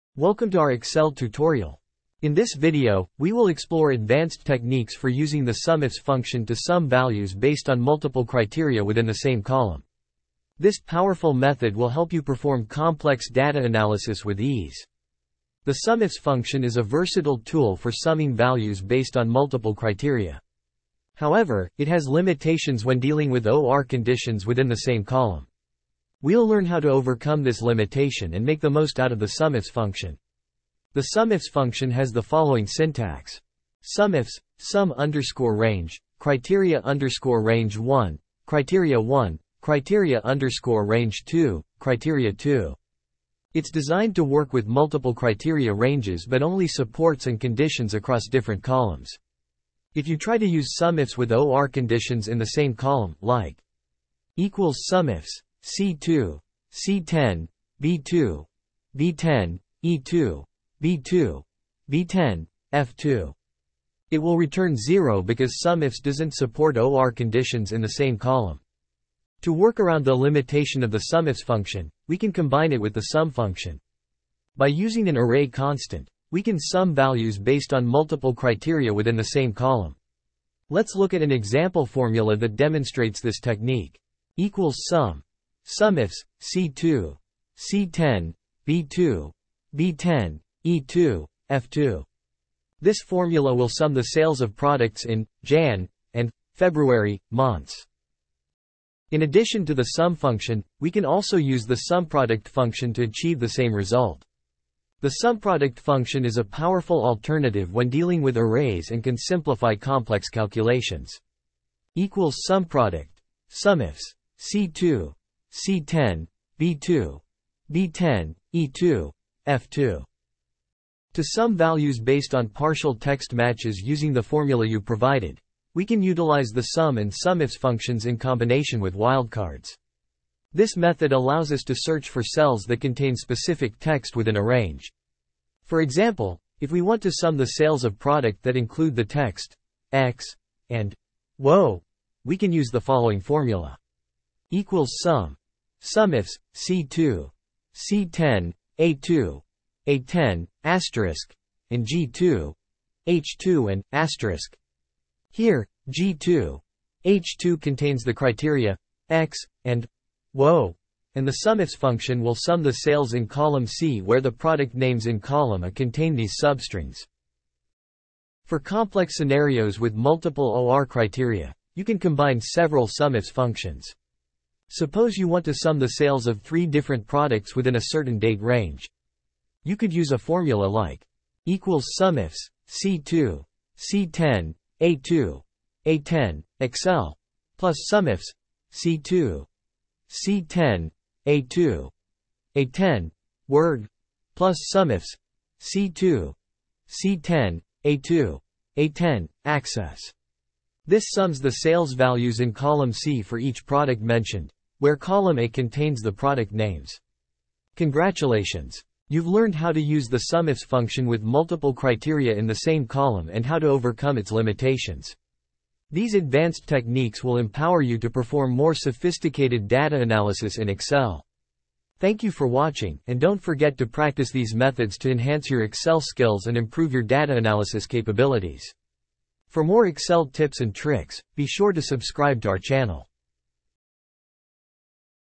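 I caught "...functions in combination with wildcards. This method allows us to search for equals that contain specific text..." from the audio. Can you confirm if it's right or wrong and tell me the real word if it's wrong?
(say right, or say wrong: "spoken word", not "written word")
wrong: "cells", not "equals".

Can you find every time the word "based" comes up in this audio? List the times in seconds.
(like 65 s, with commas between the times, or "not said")
7 s, 18 s, 77 s, 121 s.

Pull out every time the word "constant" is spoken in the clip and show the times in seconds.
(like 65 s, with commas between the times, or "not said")
75 s.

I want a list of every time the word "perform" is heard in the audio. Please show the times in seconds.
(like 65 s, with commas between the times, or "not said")
12 s, 218 s.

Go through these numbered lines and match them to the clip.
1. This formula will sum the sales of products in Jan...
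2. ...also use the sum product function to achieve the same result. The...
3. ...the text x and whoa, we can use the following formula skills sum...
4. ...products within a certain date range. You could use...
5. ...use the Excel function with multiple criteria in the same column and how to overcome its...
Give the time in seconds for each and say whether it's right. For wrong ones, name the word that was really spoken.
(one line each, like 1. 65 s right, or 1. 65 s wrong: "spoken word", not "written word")
1. 92 s right
2. 101 s right
3. 138 s wrong: "equals", not "skills"
4. 177 s right
5. 209 s wrong: "SUMIFS", not "Excel".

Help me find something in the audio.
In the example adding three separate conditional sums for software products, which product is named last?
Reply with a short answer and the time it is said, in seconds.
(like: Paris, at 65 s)
Access, at 199 s.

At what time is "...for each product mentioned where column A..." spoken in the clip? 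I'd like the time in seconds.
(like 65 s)
203 s.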